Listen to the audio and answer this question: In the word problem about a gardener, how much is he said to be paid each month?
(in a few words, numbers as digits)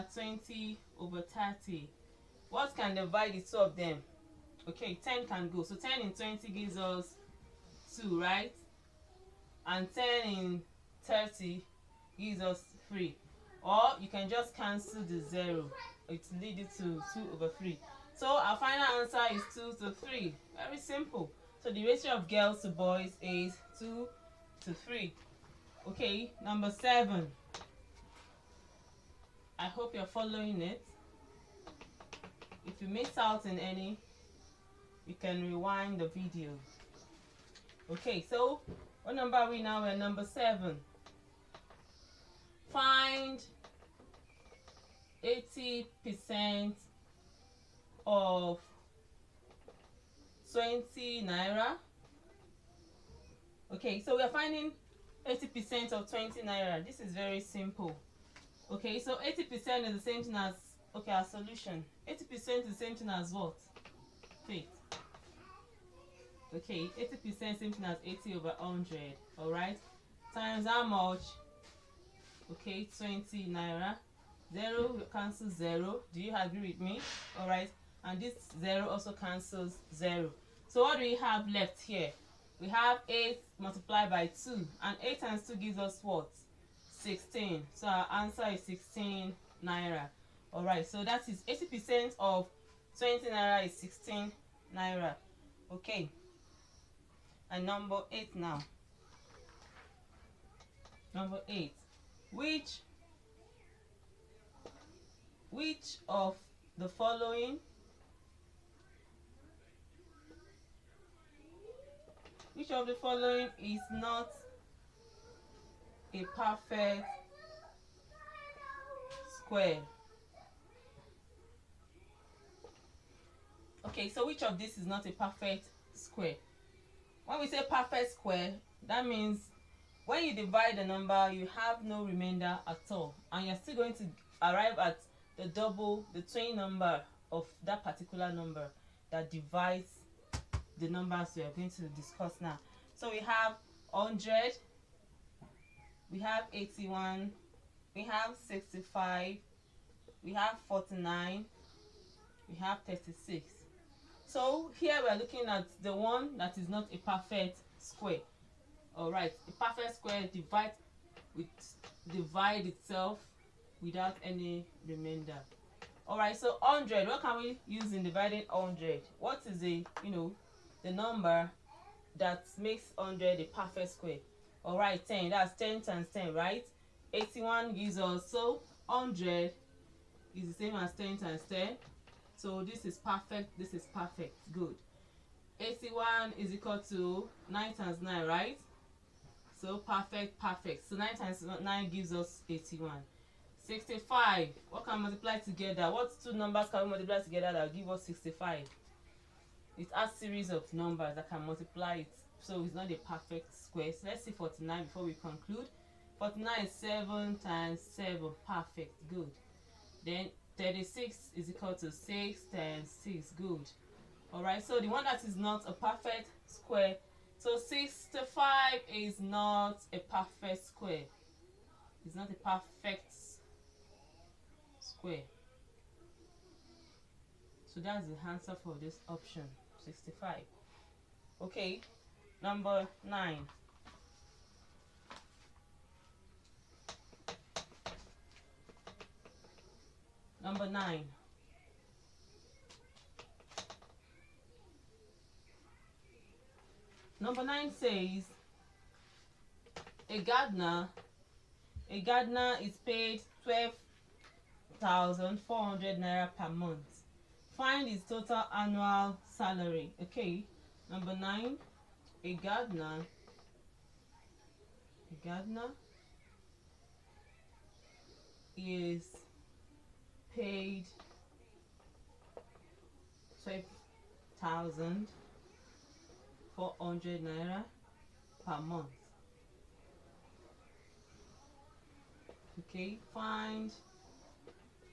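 12,400 naira.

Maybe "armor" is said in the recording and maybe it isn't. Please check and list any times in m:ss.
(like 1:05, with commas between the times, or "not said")
not said.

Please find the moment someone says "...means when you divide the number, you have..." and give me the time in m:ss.
2:09.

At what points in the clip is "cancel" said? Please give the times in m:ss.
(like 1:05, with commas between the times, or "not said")
0:14, 1:15, 1:19.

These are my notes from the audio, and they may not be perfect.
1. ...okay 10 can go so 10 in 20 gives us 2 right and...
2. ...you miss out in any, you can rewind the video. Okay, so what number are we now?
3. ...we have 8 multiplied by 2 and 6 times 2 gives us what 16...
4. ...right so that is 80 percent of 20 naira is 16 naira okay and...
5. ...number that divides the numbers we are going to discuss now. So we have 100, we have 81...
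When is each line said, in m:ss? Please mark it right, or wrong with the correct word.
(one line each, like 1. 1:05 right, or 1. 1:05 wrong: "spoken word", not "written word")
1. 0:04 right
2. 0:32 right
3. 1:22 wrong: "8", not "6"
4. 1:30 right
5. 2:18 right.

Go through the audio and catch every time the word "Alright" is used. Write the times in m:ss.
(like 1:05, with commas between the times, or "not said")
2:38, 2:46, 2:54.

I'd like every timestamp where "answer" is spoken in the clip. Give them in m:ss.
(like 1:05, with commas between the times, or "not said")
0:19, 1:28, 3:48.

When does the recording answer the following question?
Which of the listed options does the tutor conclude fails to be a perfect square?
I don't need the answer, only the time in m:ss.
3:37.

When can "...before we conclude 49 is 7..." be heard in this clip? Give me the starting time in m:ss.
3:24.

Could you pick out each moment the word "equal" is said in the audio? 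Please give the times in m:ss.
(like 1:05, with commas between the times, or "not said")
3:06, 3:31.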